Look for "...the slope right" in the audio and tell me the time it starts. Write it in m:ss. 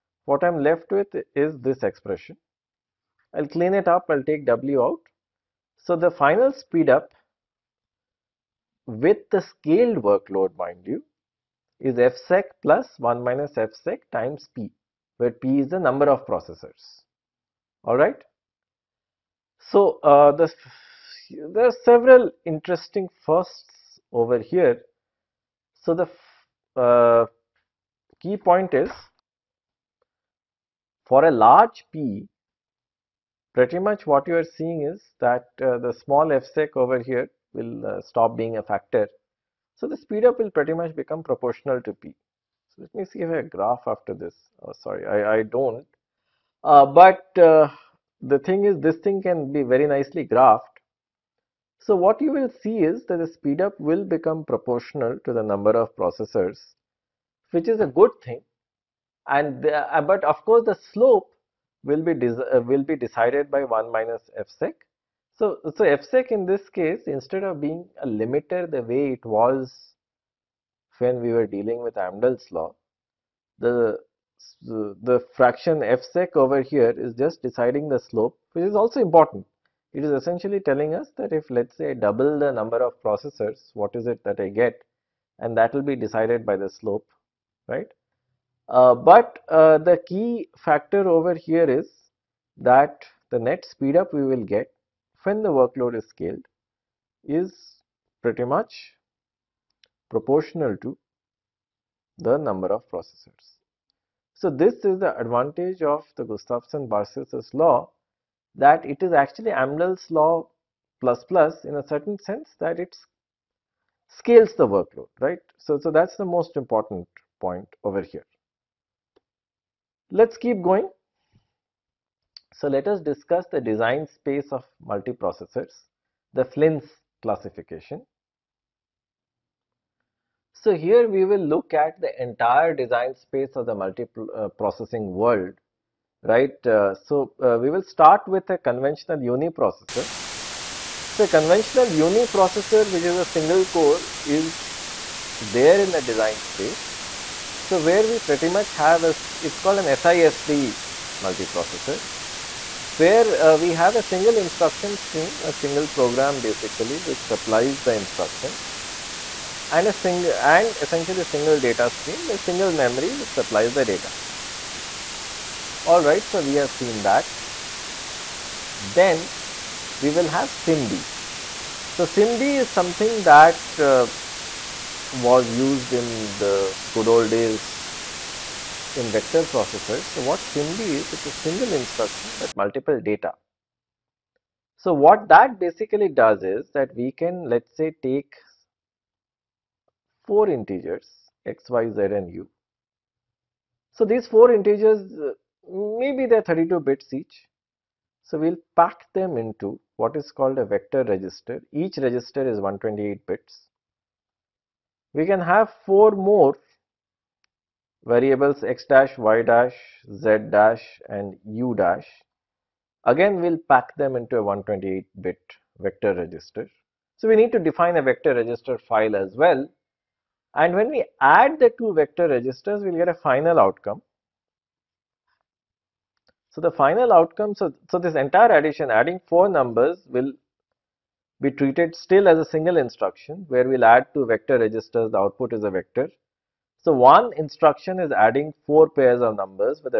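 1:26.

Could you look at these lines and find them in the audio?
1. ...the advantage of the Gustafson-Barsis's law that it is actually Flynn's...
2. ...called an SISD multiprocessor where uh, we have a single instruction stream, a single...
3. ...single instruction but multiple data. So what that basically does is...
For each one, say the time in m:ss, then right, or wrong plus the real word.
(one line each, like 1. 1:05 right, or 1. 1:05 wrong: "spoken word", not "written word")
1. 1:44 wrong: "Amdahl", not "Flynn"
2. 2:29 right
3. 3:01 right.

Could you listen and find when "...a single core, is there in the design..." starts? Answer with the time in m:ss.
2:23.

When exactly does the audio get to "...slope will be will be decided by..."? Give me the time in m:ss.
1:00.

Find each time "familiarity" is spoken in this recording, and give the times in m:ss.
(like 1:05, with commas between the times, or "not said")
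not said.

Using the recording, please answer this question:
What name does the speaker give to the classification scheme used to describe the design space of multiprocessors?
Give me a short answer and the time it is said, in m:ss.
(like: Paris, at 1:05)
Flynn's classification, at 2:06.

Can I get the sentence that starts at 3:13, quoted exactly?
So these four integers maybe they're 32 bits each.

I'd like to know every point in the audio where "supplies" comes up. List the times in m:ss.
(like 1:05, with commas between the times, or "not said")
2:37, 2:43.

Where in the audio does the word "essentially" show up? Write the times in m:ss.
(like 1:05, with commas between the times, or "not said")
1:20, 2:40.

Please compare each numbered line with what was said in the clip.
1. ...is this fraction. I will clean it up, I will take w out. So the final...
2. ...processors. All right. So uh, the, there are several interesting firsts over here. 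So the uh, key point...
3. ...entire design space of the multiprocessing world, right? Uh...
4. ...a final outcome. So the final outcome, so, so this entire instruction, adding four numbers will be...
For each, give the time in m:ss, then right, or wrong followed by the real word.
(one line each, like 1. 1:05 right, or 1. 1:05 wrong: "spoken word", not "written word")
1. 0:01 wrong: "expression", not "fraction"
2. 0:16 right
3. 2:12 right
4. 3:43 wrong: "addition", not "instruction".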